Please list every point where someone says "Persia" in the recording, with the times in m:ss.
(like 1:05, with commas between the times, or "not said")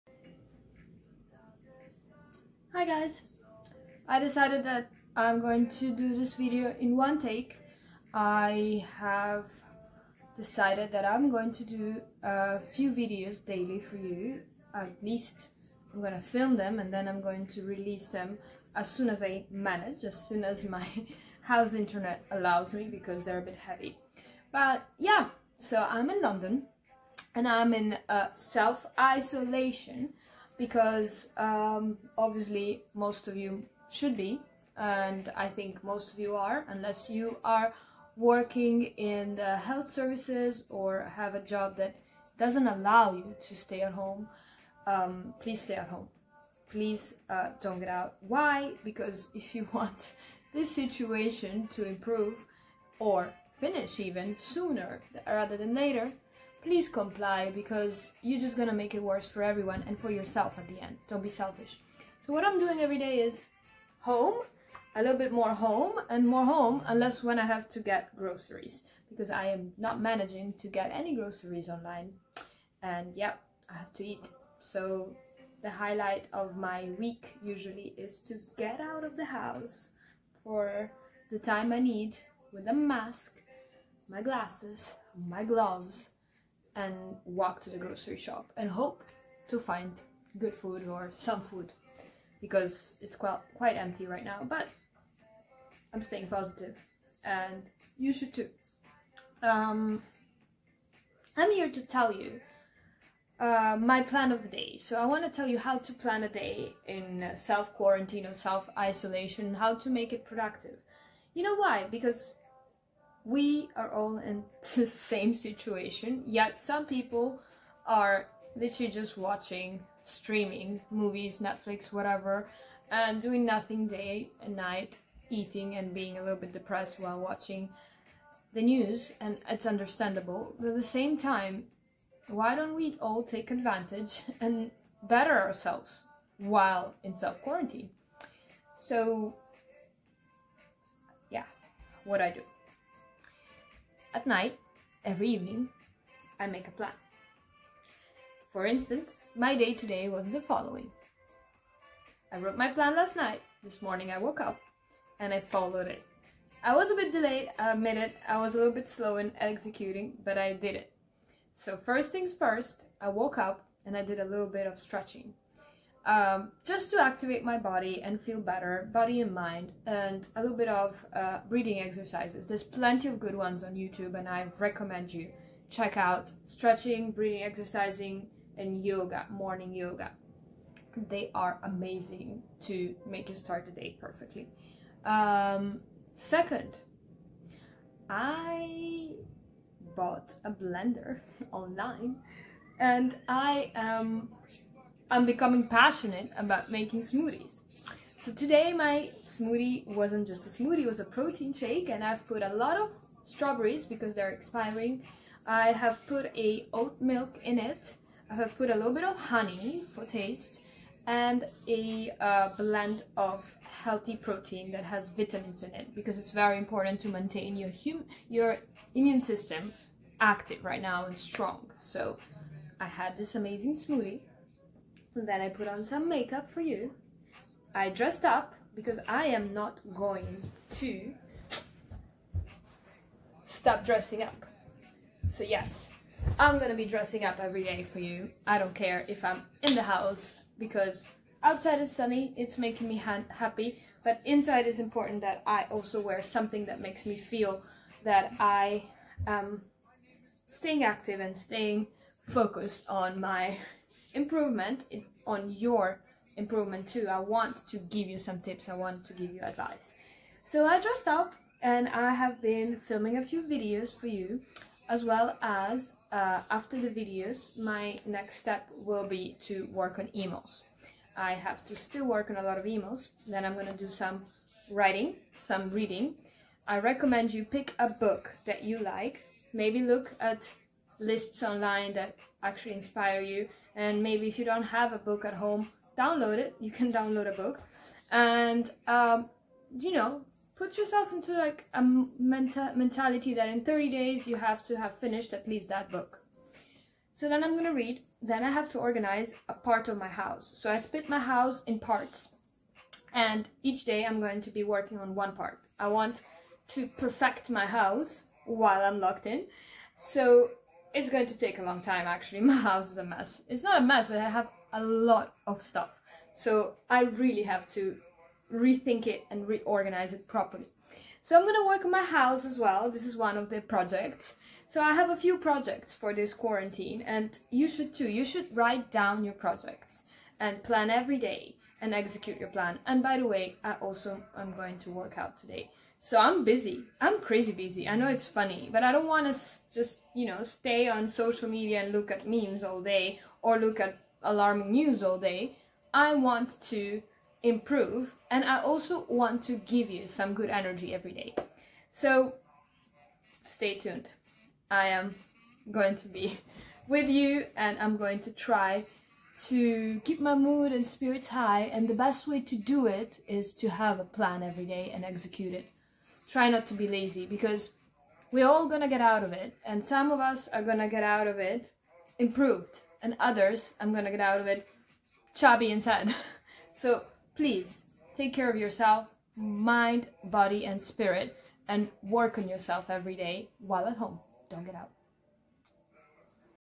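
not said.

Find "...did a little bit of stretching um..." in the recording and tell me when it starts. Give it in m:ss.
2:44.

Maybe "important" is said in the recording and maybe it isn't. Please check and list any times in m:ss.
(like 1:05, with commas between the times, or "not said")
3:36, 4:04.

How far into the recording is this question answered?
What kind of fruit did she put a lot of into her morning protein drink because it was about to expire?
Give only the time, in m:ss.
3:23.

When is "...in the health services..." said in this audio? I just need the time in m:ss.
0:39.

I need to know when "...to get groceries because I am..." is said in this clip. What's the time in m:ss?
1:07.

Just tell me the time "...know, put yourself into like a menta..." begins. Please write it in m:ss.
4:49.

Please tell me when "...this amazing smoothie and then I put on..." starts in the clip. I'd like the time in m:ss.
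3:43.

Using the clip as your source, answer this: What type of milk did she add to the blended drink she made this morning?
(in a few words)
Oat milk.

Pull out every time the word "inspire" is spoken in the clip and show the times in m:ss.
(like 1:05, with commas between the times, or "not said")
4:42.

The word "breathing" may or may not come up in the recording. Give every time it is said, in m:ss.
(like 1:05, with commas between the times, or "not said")
2:51, 2:57.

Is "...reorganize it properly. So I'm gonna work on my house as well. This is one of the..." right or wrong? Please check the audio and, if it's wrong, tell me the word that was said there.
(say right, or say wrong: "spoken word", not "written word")
right.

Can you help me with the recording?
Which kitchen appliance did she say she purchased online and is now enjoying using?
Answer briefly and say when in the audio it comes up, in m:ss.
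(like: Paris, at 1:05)
A blender, at 3:10.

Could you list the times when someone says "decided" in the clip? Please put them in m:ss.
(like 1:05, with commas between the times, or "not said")
0:04, 0:10.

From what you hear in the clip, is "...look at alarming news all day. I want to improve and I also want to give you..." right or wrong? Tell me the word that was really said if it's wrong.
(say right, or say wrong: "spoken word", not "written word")
right.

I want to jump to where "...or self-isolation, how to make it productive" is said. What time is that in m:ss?
1:48.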